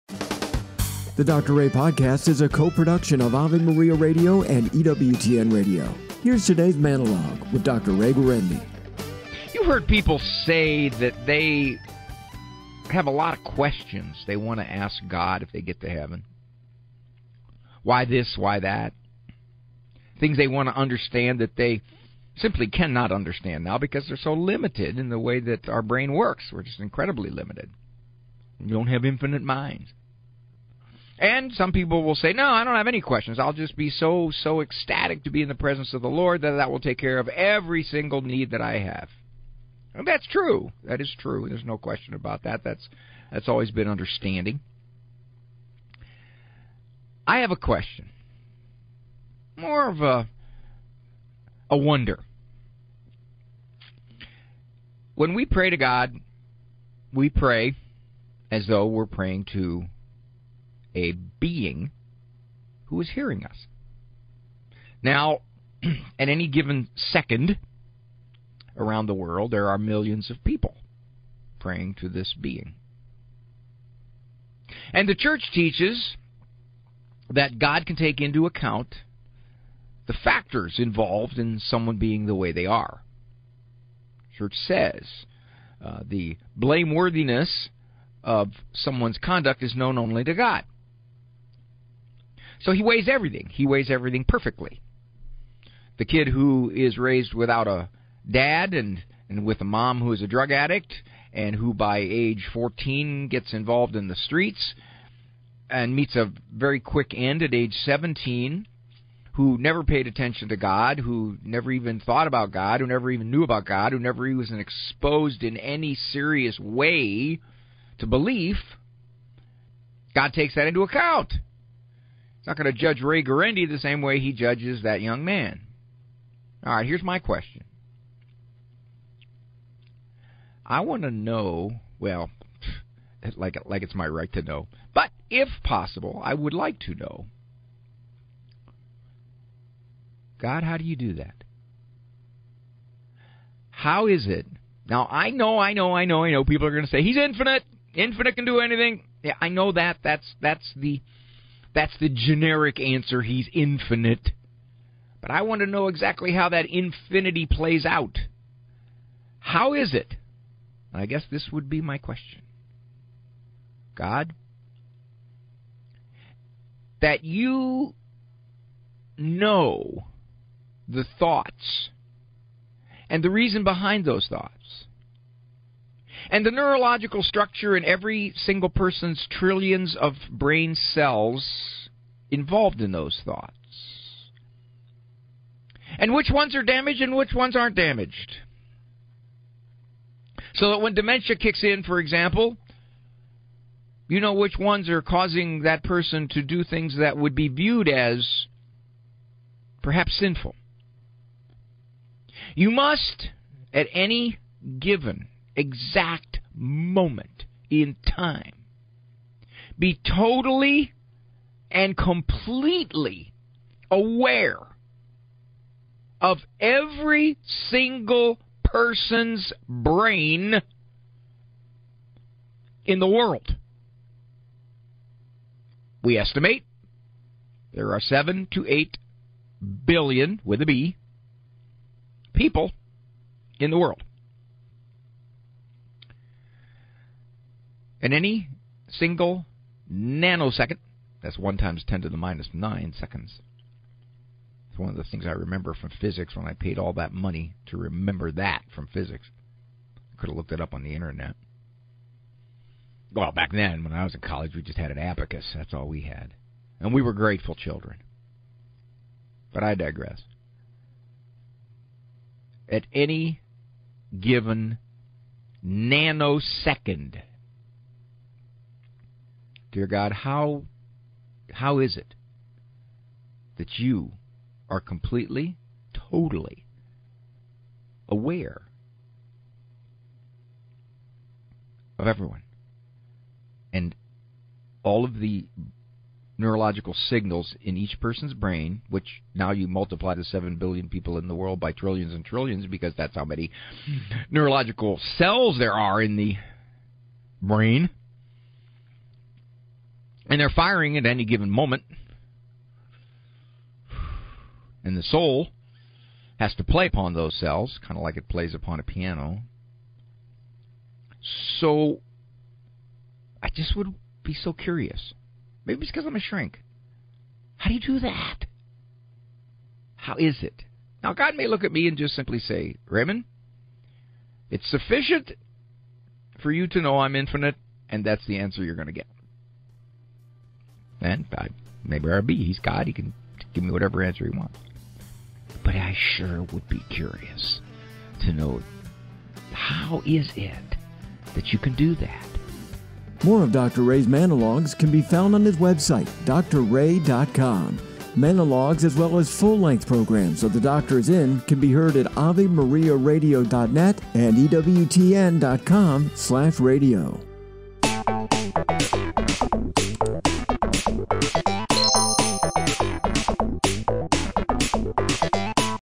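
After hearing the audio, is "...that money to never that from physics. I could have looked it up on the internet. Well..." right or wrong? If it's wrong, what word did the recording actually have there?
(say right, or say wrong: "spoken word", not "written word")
wrong: "remember", not "never".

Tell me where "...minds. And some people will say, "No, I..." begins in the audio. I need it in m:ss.
0:29.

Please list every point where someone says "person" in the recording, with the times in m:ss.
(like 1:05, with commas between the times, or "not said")
2:58, 3:15, 3:38, 4:47.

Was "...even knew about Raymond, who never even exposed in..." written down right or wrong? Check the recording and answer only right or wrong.
wrong.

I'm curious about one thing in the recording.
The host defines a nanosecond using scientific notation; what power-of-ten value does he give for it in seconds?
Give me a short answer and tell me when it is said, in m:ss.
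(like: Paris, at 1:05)
1 times 10 to the minus 9, at 4:01.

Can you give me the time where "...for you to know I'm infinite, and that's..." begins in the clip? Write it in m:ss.
5:26.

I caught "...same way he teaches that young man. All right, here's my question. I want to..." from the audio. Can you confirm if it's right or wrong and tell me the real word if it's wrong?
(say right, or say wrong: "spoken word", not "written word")
wrong: "judges", not "teaches".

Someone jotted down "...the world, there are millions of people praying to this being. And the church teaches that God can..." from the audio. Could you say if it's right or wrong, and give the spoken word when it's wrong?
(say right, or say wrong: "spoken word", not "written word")
right.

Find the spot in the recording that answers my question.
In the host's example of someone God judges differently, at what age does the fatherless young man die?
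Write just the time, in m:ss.
1:47.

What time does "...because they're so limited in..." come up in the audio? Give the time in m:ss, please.
0:23.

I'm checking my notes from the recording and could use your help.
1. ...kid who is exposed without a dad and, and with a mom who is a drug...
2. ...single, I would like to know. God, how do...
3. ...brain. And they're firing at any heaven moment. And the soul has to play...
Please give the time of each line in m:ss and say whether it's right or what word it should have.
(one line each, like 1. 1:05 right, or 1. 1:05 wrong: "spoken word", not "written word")
1. 1:36 wrong: "raised", not "exposed"
2. 2:15 wrong: "possible", not "single"
3. 4:57 wrong: "given", not "heaven".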